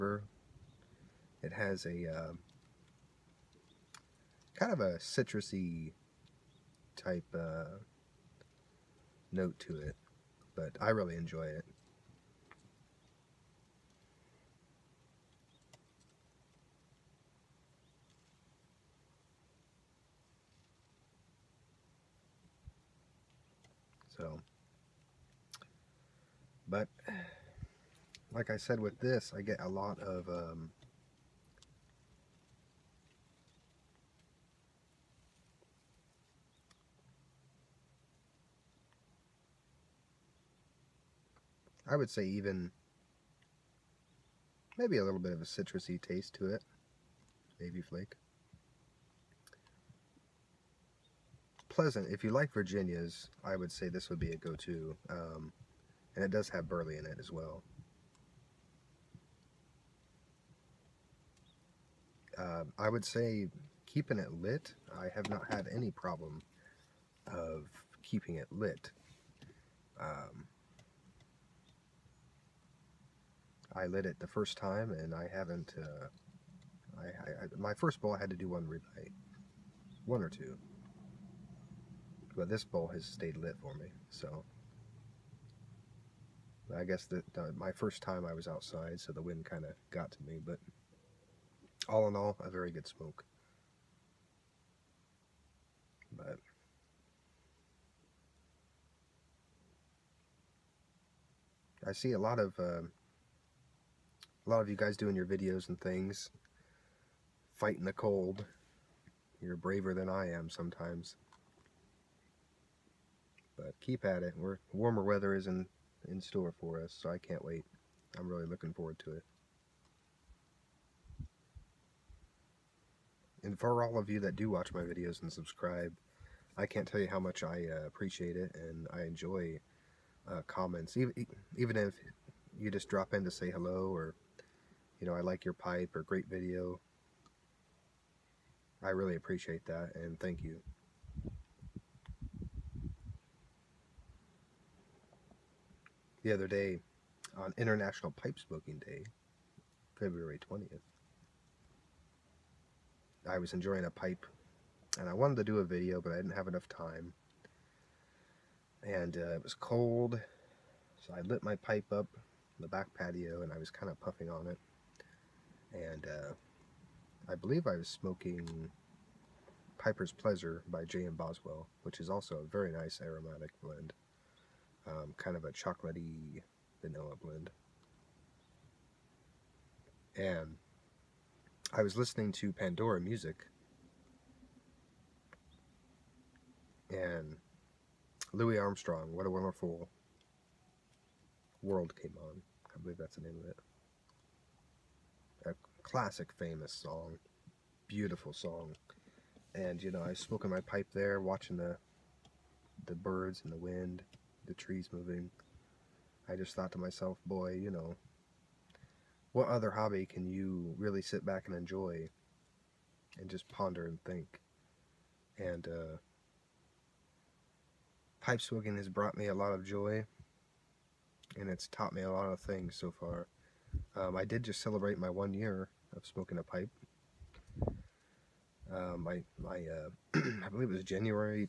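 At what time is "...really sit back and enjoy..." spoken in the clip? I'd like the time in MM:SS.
03:30.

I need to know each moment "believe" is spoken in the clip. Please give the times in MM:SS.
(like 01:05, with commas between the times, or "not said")
02:47, 03:12, 03:50.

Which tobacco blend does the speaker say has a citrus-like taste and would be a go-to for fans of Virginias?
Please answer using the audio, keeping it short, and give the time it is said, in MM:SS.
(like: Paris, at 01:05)
Navy Flake, at 00:47.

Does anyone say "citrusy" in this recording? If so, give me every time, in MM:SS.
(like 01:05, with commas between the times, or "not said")
00:04, 00:45.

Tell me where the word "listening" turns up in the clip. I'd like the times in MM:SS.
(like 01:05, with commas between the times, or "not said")
03:01.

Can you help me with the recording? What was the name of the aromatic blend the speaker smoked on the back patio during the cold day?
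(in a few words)
Piper's Pleasure.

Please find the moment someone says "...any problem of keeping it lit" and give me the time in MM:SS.
01:05.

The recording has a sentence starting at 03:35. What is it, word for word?
And uh, pipe smoking has brought me a lot of joy and it's taught me a lot of things so far.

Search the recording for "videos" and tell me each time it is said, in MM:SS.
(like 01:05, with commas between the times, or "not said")
01:45, 02:04, 02:16, 02:35.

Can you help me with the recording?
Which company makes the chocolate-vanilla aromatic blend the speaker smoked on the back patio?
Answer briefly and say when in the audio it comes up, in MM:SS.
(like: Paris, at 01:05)
J.M. Boswell, at 02:50.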